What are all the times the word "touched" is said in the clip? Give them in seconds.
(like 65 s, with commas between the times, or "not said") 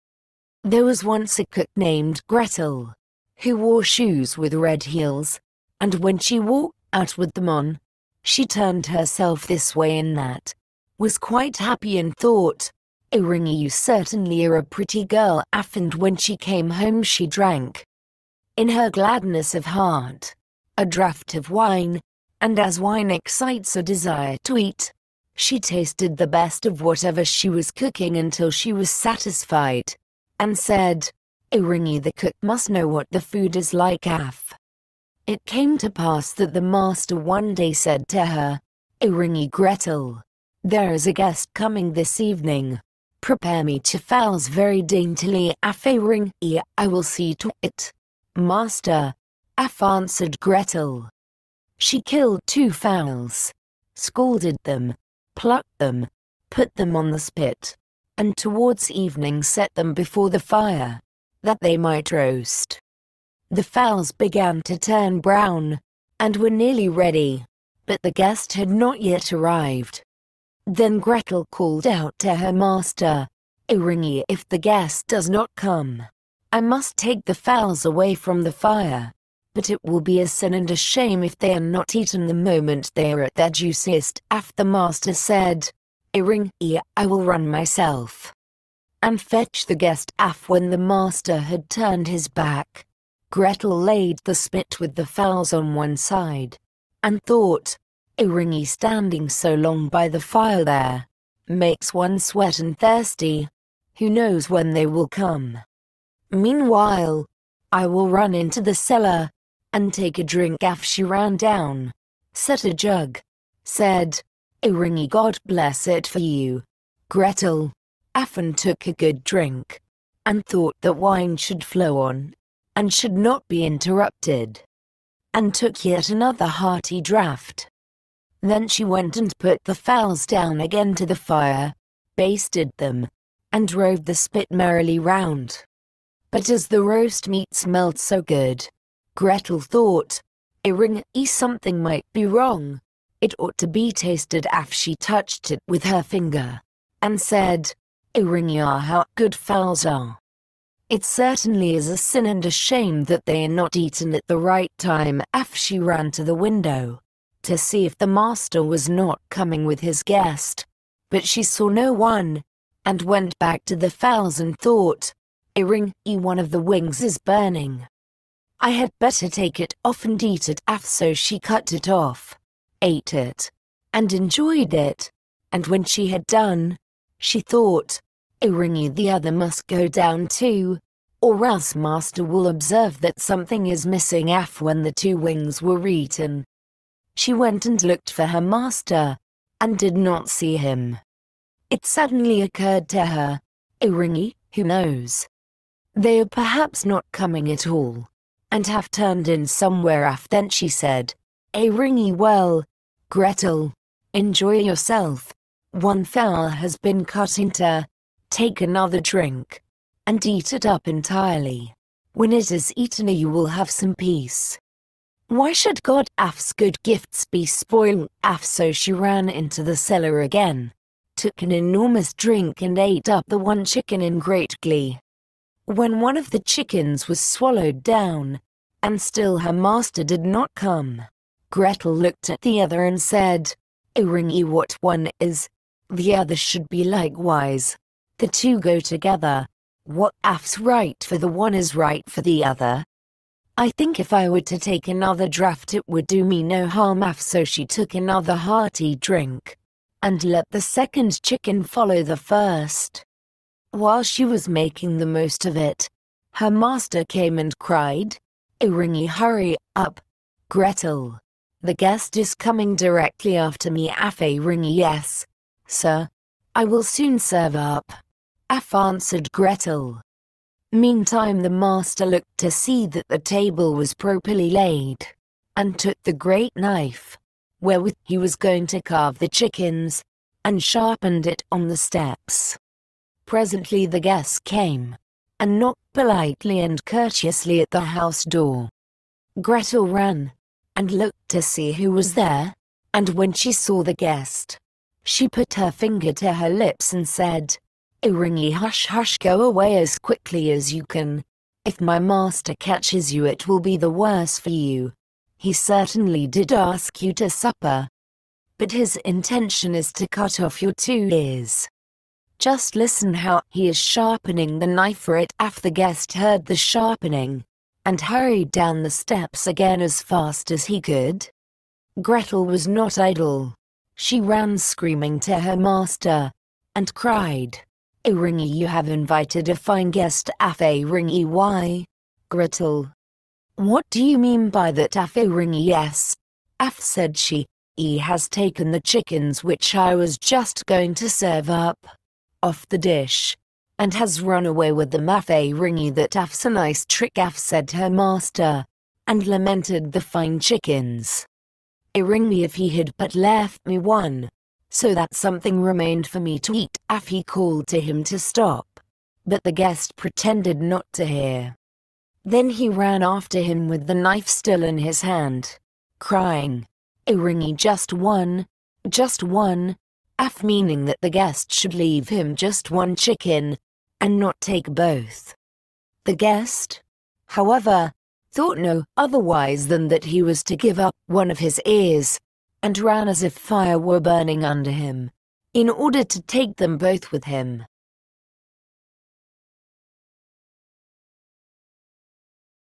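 144 s.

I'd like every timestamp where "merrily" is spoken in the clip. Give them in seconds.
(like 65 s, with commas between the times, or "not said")
134 s.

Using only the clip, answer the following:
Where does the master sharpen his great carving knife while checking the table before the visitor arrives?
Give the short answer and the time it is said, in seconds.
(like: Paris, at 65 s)
On the steps, at 281 s.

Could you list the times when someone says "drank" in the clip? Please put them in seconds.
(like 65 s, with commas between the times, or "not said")
17 s.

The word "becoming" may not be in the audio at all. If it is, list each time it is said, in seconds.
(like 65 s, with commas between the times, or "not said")
not said.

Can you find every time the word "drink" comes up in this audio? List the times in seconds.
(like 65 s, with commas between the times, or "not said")
110 s, 119 s, 209 s, 222 s, 248 s.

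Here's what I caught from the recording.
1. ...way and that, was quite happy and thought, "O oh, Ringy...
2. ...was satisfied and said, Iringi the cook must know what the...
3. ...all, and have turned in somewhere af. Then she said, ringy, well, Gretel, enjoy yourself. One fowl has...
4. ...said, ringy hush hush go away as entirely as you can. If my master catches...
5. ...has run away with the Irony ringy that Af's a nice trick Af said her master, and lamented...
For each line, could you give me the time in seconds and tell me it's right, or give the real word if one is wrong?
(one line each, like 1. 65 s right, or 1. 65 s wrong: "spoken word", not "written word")
1. 9 s right
2. 28 s right
3. 197 s right
4. 297 s wrong: "quickly", not "entirely"
5. 343 s wrong: "Maffei", not "Irony".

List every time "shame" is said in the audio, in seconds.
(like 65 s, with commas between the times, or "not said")
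80 s, 152 s.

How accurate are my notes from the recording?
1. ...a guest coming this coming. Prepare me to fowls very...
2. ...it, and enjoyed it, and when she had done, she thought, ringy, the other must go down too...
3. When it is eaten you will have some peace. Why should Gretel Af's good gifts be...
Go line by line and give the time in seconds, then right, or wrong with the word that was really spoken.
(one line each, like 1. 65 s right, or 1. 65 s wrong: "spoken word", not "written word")
1. 41 s wrong: "evening", not "coming"
2. 173 s right
3. 212 s wrong: "God", not "Gretel".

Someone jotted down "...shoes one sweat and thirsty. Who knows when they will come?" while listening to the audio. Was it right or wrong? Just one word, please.
wrong.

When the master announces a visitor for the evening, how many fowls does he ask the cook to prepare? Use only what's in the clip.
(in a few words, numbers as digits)
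2.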